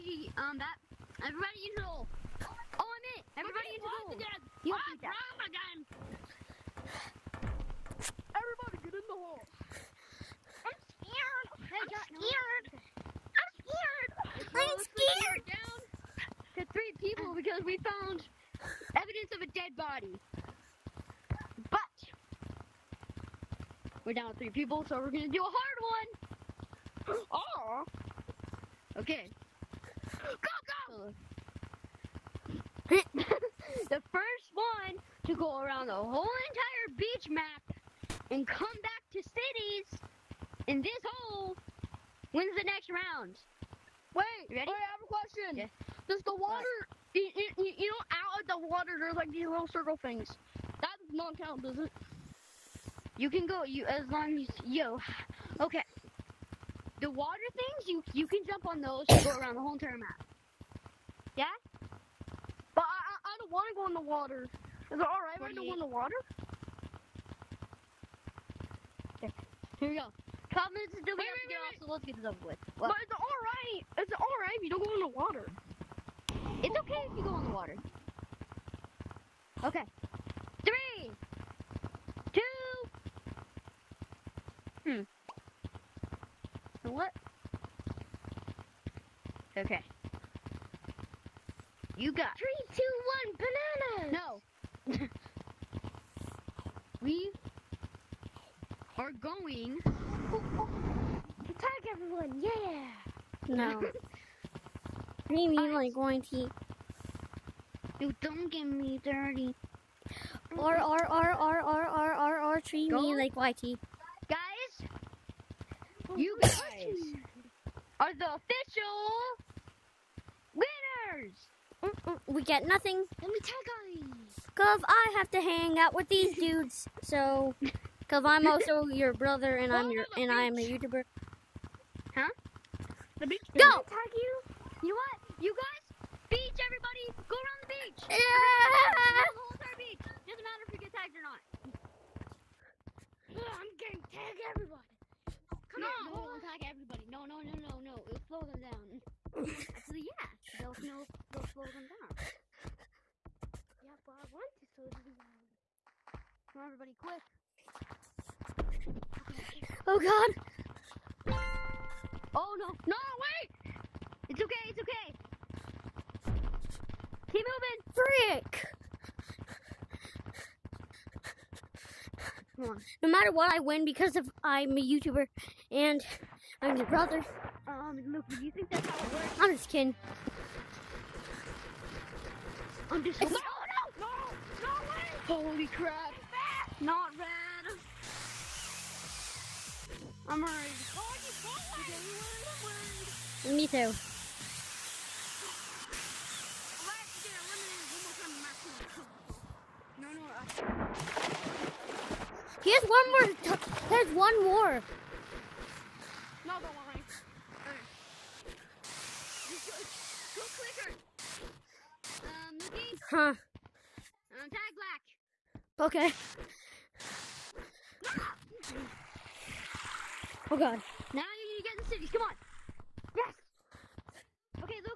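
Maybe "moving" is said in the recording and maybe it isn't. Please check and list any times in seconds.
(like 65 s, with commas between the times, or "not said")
167 s.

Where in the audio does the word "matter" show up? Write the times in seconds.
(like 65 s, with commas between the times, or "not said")
140 s, 173 s.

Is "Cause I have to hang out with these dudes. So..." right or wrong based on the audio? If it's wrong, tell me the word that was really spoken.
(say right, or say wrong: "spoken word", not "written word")
right.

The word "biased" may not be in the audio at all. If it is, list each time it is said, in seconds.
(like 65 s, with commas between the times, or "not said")
not said.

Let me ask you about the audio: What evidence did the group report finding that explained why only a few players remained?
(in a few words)
A dead body.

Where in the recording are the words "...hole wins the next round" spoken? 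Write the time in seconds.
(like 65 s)
41 s.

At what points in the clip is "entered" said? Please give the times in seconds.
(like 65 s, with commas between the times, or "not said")
not said.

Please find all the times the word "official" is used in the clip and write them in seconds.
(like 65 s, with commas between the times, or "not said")
118 s.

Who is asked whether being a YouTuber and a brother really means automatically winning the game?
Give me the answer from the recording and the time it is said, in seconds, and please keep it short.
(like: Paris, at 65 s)
Luke, at 178 s.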